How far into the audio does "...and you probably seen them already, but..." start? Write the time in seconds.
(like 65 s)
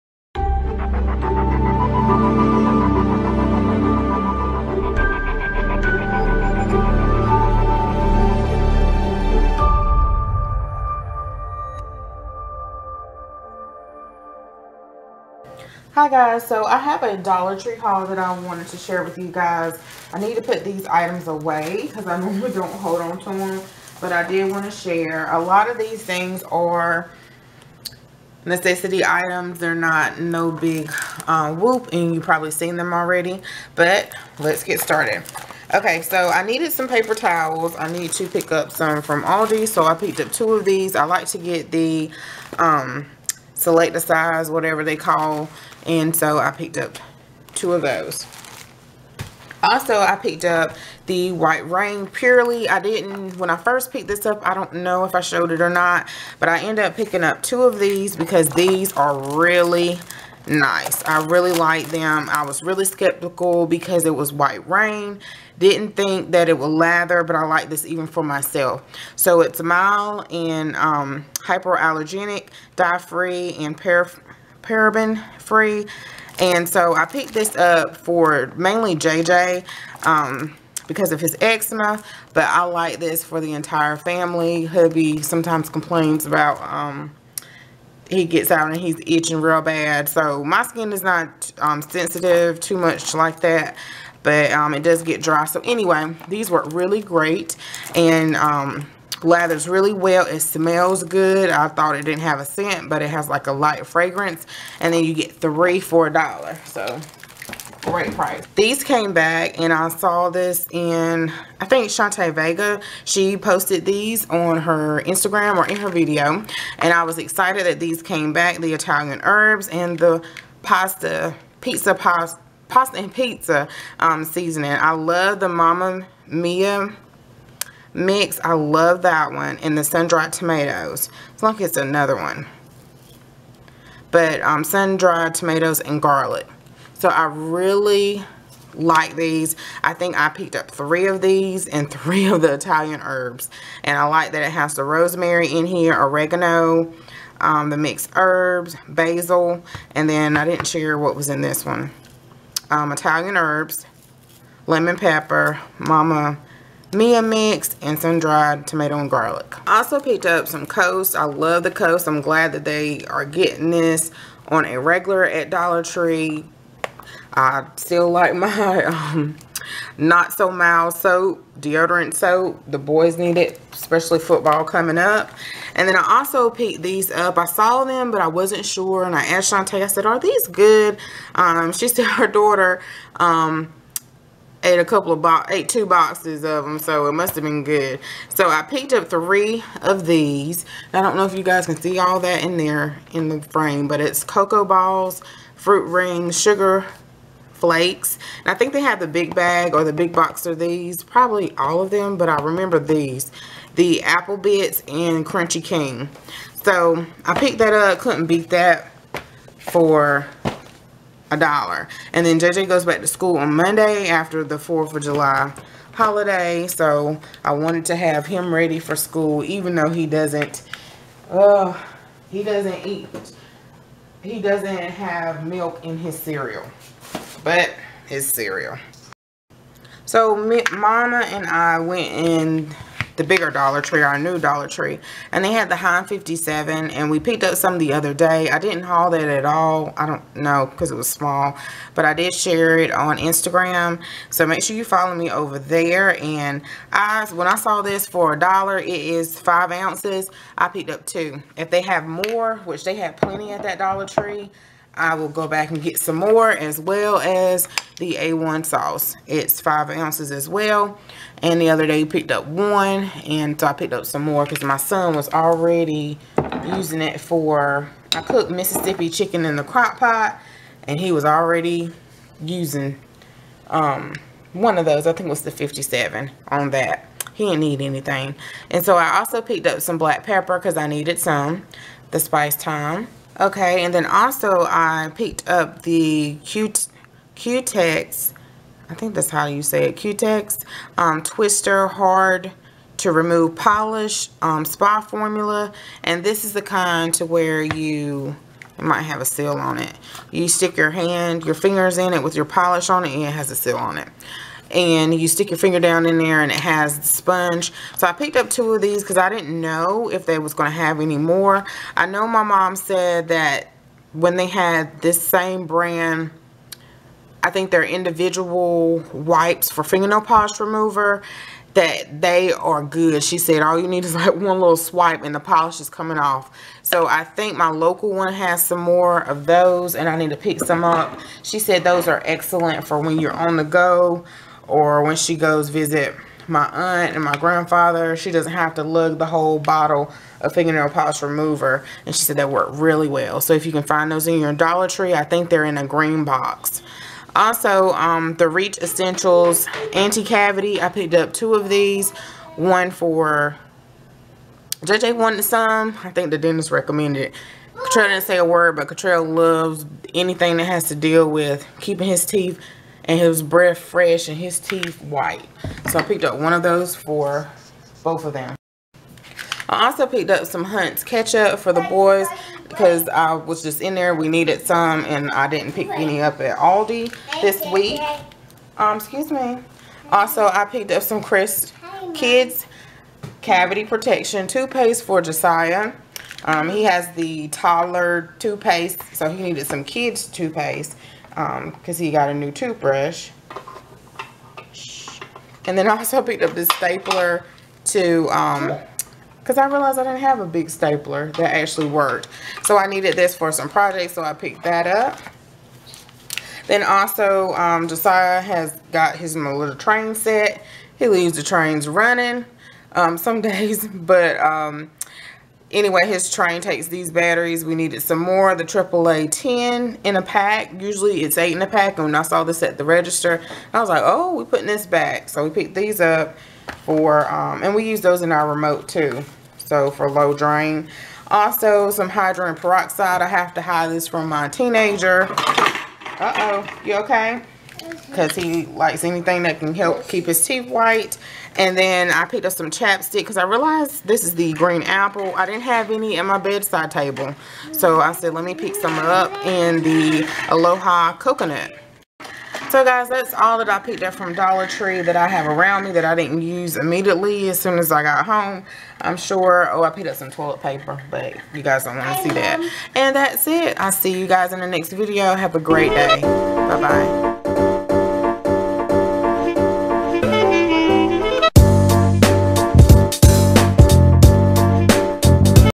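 31 s.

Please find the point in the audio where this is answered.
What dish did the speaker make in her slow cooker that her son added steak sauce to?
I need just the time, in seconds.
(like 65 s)
268 s.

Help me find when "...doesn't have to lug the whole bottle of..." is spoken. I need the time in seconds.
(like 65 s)
338 s.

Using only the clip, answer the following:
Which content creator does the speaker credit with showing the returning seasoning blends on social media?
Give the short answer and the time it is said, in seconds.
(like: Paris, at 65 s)
Shantae Vega, at 111 s.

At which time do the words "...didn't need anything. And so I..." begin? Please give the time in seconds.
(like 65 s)
277 s.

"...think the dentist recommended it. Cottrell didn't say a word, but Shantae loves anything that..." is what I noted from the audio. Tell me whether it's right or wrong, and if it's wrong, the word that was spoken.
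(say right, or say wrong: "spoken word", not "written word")
wrong: "Cottrell", not "Shantae".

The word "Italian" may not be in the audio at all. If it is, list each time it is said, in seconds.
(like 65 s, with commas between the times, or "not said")
118 s, 142 s, 152 s.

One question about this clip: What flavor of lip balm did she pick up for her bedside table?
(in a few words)
Aloha Coconut.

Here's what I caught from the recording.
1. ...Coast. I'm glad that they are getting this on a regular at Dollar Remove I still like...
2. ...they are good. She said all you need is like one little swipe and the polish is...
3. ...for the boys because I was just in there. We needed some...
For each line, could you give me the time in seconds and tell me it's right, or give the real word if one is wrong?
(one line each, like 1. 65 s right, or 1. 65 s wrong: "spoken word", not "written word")
1. 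161 s wrong: "Tree", not "Remove"
2. 322 s right
3. 371 s right.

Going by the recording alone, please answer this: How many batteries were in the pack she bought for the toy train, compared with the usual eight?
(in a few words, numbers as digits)
10.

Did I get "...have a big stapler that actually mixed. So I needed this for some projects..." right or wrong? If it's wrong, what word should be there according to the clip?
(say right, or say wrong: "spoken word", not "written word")
wrong: "worked", not "mixed".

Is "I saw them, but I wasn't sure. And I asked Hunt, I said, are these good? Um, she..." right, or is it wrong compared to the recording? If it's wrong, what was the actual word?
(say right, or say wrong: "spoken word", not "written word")
wrong: "Shantae", not "Hunt".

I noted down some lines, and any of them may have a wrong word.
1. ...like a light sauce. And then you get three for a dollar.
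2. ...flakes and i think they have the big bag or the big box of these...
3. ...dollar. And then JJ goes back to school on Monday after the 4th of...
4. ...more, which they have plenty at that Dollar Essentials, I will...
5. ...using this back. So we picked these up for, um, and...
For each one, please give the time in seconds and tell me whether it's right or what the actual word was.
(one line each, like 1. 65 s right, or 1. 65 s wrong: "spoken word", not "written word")
1. 103 s wrong: "fragrance", not "sauce"
2. 197 s right
3. 211 s right
4. 252 s wrong: "Tree", not "Essentials"
5. 424 s wrong: "putting", not "using".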